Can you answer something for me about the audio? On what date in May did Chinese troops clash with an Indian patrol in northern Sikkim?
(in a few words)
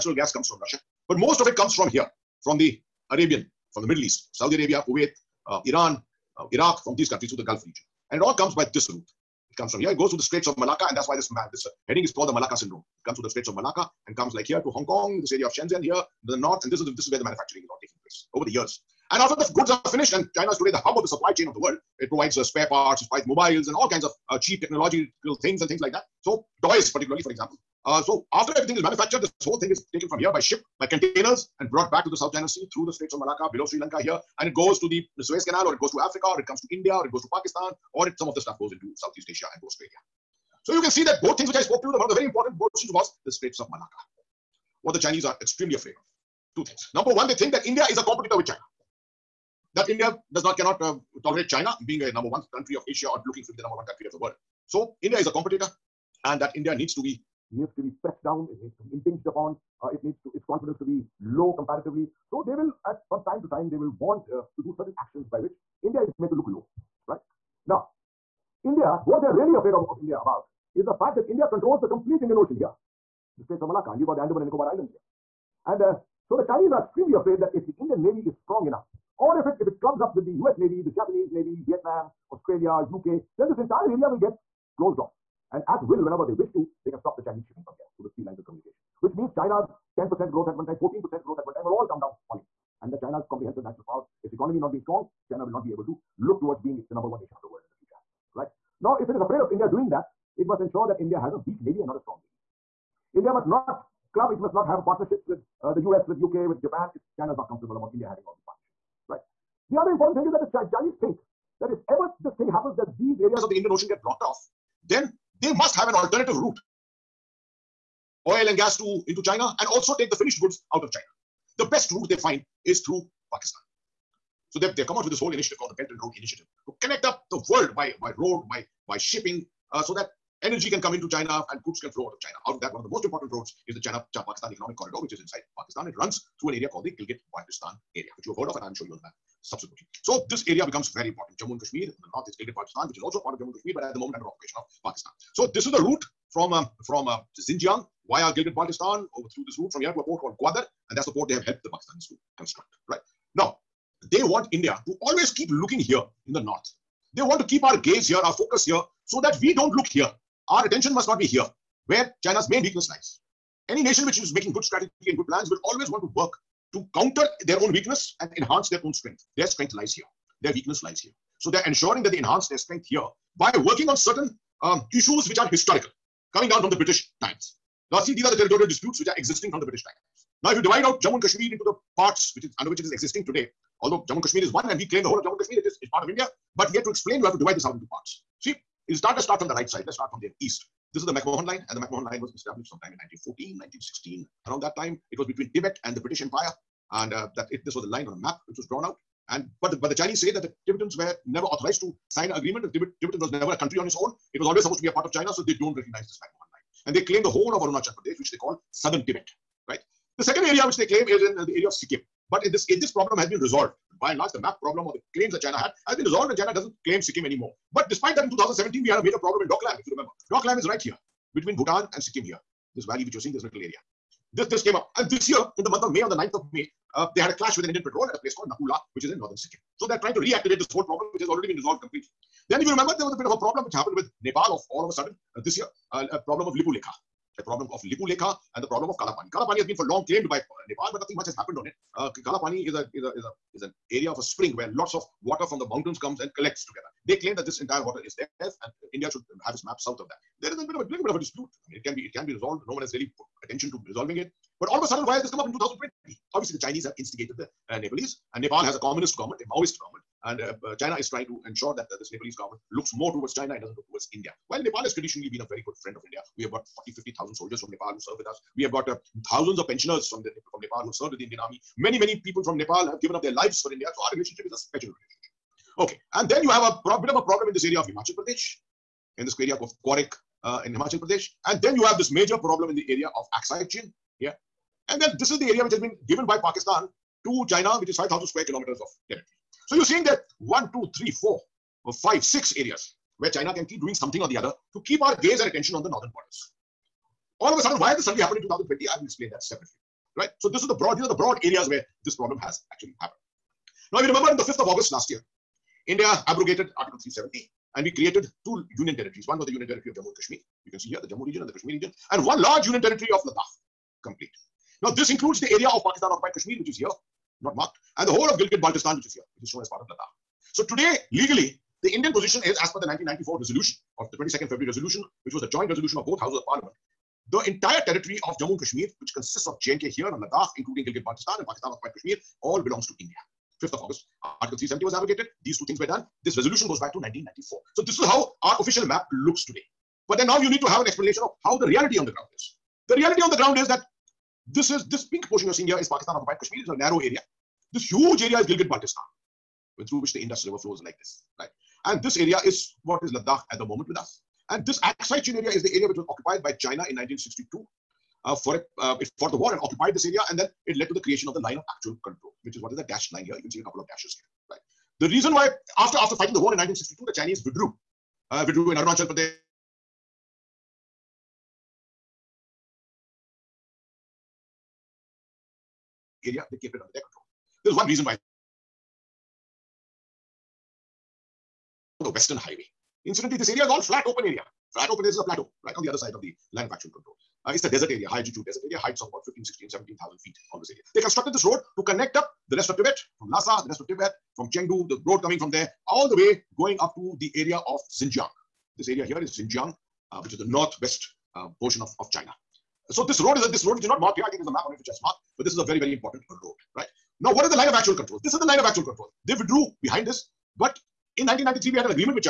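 9th of May.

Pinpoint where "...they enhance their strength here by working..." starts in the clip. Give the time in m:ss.
2:52.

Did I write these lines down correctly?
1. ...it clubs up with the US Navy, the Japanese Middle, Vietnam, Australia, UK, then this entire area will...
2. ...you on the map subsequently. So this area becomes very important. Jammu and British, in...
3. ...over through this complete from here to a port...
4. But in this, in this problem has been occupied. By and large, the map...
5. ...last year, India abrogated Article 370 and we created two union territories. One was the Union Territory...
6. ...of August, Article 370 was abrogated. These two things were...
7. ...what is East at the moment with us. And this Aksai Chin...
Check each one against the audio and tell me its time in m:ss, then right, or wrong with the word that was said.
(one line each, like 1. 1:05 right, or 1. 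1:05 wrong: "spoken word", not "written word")
1. 1:19 wrong: "Navy", not "Middle"
2. 2:18 wrong: "Kashmir", not "British"
3. 2:29 wrong: "route", not "complete"
4. 3:32 wrong: "resolved", not "occupied"
5. 5:04 right
6. 5:33 right
7. 5:52 wrong: "Ladakh", not "East".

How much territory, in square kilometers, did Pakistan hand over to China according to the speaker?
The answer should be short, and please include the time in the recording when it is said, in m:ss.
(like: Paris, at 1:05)
5,000 square kilometers, at 4:47.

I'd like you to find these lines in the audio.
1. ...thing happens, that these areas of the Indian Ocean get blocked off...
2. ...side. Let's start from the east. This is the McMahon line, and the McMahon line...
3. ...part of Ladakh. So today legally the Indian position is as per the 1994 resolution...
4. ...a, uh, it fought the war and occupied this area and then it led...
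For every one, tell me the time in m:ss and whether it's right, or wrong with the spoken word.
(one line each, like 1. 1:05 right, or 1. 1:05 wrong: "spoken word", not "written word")
1. 1:52 right
2. 3:09 right
3. 5:19 right
4. 5:58 right.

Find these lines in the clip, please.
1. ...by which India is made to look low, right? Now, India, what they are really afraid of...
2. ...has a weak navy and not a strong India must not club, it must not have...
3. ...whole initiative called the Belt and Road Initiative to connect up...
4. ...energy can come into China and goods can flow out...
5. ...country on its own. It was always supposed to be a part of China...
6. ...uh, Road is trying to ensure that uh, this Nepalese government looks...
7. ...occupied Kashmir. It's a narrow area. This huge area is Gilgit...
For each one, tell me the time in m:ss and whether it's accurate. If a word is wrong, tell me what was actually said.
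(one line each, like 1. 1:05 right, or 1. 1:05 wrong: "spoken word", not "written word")
1. 1:05 right
2. 1:41 right
3. 2:05 right
4. 2:10 right
5. 3:23 right
6. 4:20 wrong: "China", not "Road"
7. 5:46 right.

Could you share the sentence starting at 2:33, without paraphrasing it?
Now, they want India to always keep looking here in the north.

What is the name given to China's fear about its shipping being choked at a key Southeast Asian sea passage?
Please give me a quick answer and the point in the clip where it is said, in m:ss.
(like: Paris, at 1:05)
Malacca Syndrome, at 0:12.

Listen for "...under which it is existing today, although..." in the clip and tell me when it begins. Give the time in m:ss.
3:02.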